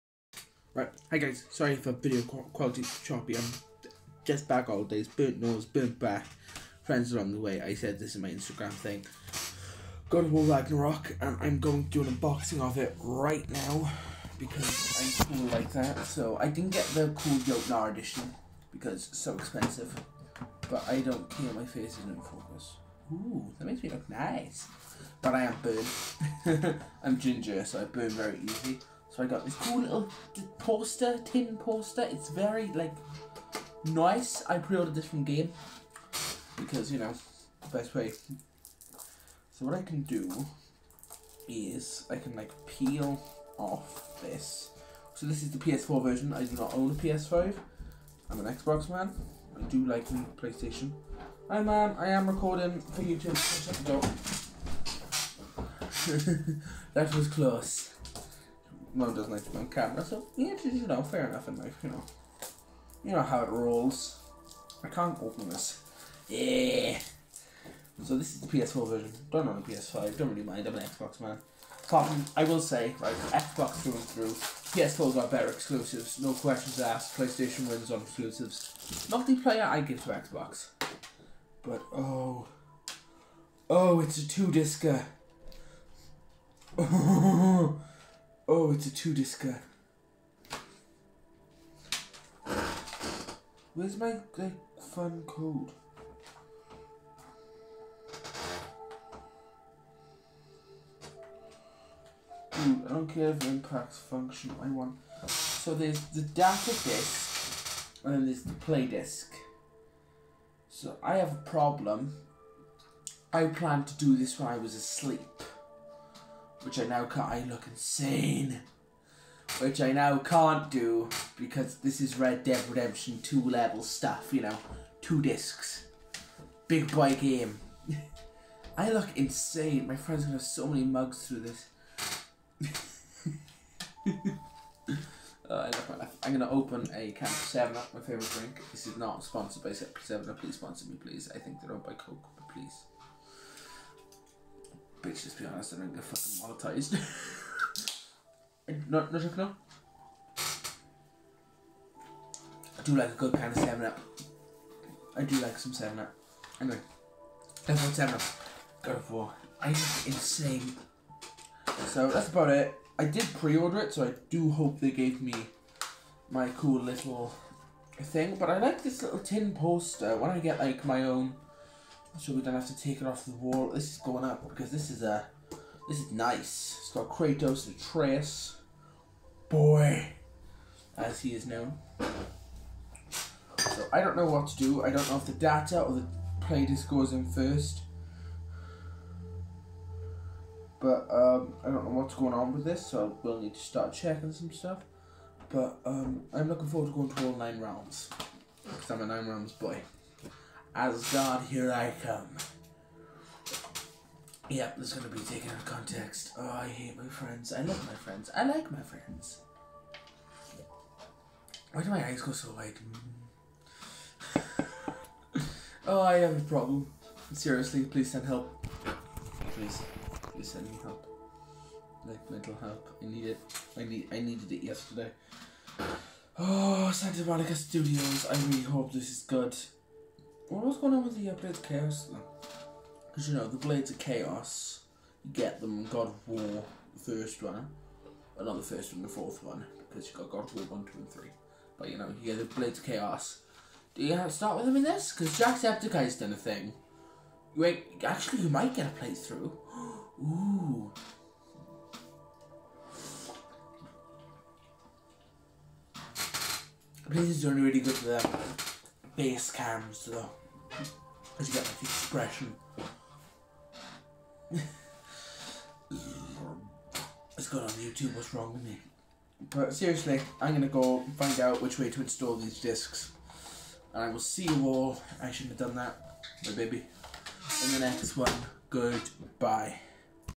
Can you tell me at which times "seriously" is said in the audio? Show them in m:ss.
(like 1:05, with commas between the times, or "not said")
3:37, 4:29.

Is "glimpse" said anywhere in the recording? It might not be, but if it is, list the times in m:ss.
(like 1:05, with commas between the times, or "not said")
not said.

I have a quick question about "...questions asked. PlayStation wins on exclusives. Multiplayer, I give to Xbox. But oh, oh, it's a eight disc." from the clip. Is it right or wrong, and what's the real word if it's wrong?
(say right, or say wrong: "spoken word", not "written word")
wrong: "two", not "eight".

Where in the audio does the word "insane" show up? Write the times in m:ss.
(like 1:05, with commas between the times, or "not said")
1:57, 2:09, 2:40.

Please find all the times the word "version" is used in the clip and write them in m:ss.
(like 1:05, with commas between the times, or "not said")
0:46, 1:08.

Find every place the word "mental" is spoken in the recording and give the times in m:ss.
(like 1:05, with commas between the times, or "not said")
3:42.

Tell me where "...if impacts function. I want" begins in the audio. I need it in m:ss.
1:43.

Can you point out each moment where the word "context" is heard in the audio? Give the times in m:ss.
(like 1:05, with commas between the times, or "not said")
3:25.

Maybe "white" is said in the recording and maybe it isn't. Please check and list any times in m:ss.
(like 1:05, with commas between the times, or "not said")
3:32.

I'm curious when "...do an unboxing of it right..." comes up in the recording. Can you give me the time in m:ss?
0:11.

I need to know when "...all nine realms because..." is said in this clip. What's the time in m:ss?
3:17.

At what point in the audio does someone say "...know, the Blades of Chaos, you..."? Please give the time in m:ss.
3:53.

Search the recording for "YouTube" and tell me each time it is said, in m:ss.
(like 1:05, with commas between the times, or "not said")
0:53, 4:27.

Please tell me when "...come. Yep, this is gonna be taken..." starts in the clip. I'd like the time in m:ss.
3:22.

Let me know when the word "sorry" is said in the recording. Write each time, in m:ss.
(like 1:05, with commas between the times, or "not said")
0:01.